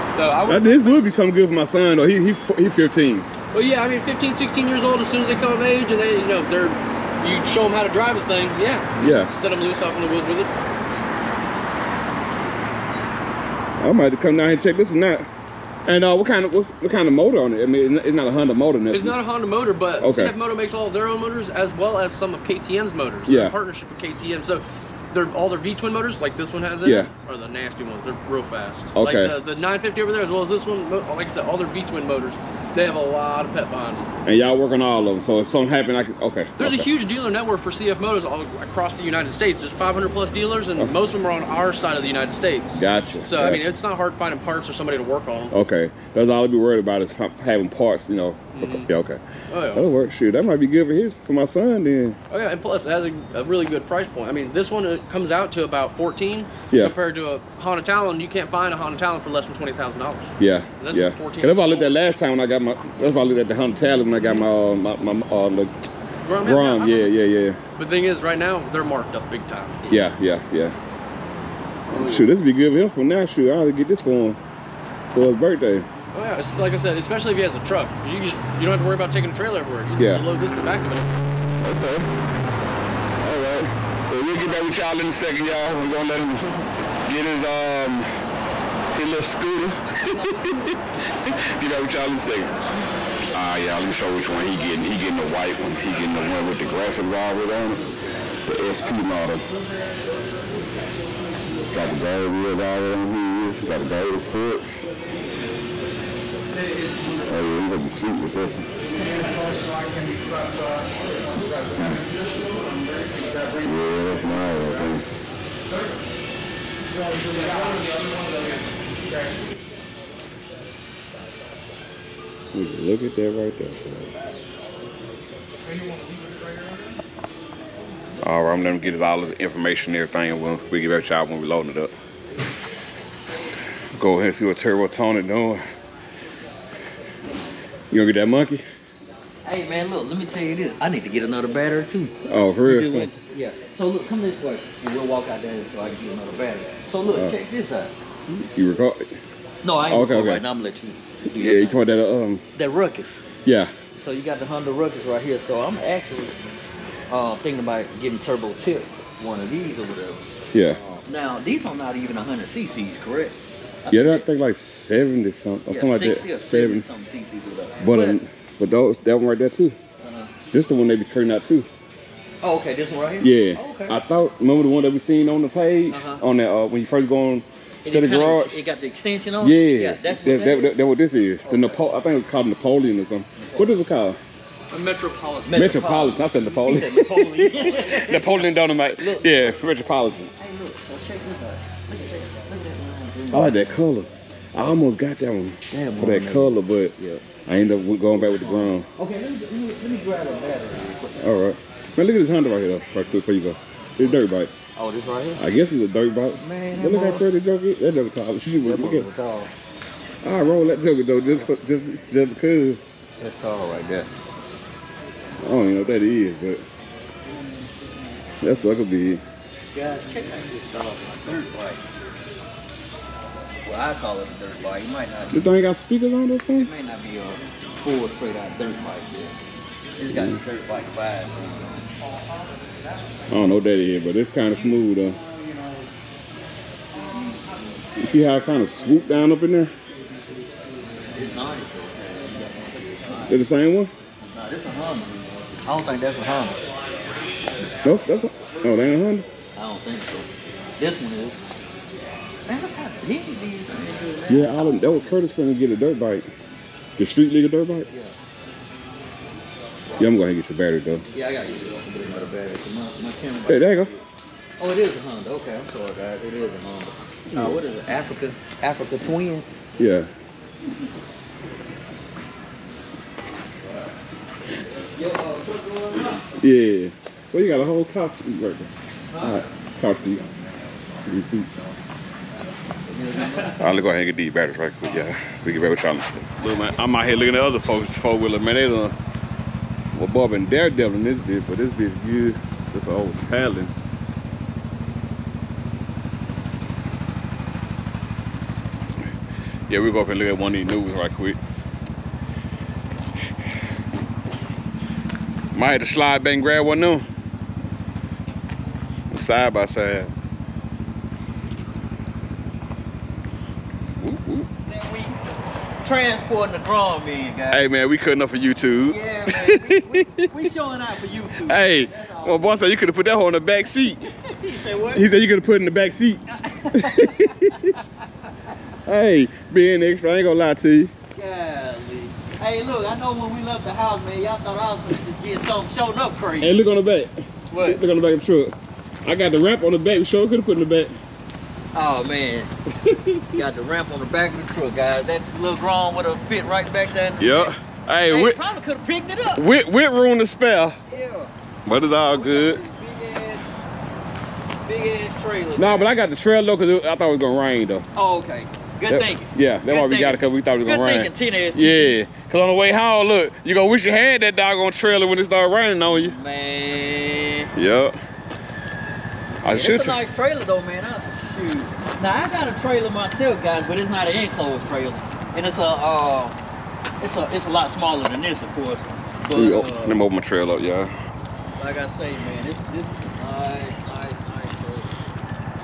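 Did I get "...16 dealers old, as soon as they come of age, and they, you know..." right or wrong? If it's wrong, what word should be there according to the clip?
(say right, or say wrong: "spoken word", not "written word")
wrong: "years", not "dealers".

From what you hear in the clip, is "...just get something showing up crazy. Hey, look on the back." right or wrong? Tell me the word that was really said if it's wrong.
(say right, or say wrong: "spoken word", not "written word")
right.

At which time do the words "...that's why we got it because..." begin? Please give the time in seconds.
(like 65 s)
359 s.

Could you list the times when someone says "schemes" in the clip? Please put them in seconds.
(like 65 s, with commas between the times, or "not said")
not said.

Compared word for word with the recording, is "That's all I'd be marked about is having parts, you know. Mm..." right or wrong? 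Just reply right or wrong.
wrong.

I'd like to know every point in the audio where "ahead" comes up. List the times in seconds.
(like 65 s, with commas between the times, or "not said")
134 s, 283 s.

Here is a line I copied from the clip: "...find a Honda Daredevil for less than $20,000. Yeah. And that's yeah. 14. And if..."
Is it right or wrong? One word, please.
wrong.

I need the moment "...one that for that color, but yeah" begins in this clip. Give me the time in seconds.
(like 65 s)
195 s.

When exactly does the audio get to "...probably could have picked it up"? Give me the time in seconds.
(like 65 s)
348 s.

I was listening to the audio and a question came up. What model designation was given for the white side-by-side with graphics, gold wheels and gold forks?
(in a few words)
SP.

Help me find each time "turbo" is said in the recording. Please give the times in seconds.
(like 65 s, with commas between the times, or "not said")
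134 s, 158 s.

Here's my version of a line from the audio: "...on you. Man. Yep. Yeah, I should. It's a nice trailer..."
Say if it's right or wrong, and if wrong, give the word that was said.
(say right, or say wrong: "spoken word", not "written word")
right.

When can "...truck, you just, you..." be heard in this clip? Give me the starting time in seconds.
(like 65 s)
77 s.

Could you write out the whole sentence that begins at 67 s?
But the thing is, right now, they're marked up big time.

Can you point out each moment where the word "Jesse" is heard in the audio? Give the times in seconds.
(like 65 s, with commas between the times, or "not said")
not said.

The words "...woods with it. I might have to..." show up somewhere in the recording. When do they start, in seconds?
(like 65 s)
10 s.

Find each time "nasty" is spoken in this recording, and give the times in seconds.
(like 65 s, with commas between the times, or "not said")
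27 s.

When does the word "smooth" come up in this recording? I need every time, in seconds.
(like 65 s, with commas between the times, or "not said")
234 s.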